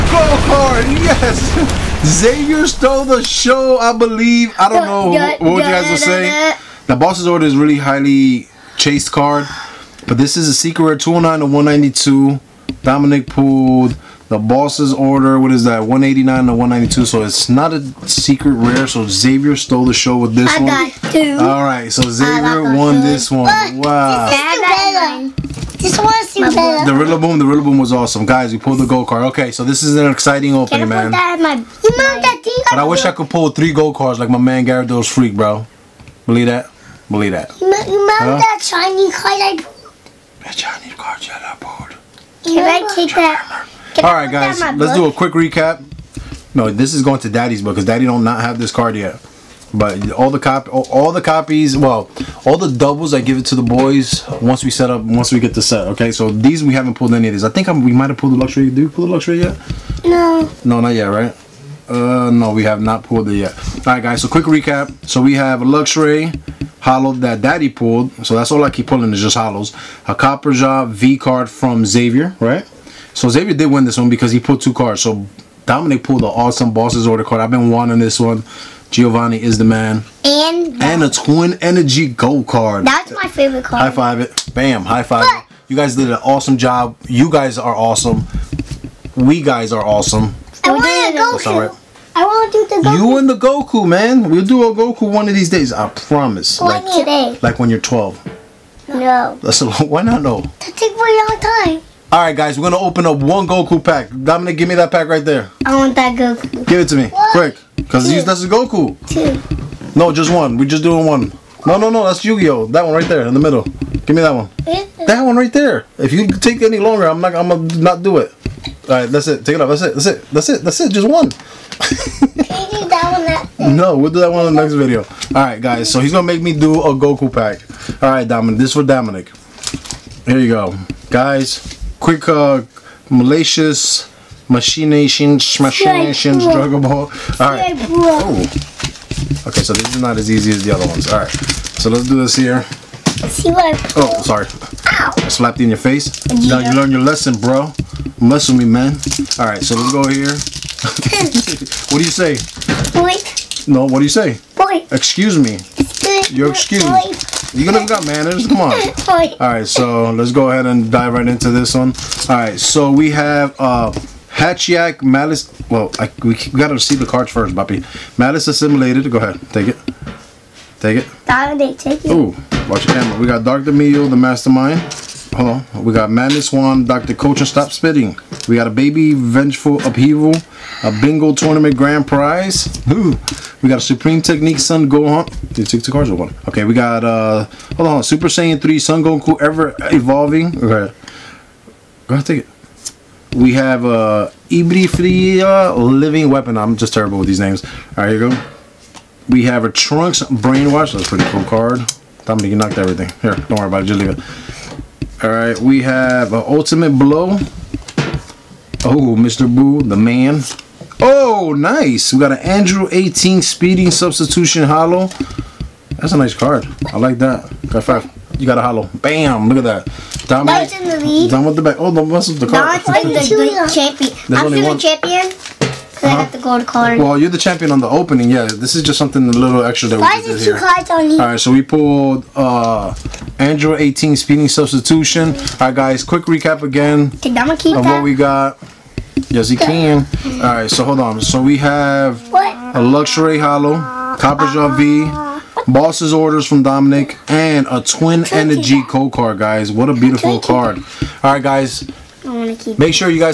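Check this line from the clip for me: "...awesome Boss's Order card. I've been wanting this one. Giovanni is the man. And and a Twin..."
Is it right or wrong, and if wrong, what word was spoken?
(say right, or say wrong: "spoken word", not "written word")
right.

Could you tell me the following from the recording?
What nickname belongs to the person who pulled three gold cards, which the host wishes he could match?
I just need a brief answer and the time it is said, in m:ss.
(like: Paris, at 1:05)
Gyarados Freak, at 0:34.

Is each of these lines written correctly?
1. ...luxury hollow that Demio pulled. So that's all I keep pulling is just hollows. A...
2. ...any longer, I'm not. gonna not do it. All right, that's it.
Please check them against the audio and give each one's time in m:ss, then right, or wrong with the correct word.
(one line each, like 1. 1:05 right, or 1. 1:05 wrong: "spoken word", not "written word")
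1. 1:05 wrong: "Daddy", not "Demio"
2. 1:56 right.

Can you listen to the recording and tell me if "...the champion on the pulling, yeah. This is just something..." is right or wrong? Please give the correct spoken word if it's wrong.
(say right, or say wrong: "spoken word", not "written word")
wrong: "opening", not "pulling".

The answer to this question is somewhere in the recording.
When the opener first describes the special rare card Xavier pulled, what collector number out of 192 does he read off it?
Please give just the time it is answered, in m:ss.
0:10.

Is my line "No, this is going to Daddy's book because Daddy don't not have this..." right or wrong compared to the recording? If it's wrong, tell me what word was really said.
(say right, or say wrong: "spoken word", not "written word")
right.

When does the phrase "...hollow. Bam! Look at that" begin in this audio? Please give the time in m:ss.
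3:38.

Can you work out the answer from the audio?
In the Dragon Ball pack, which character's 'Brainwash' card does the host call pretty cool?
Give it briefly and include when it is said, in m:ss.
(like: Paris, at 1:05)
Trunks, at 3:19.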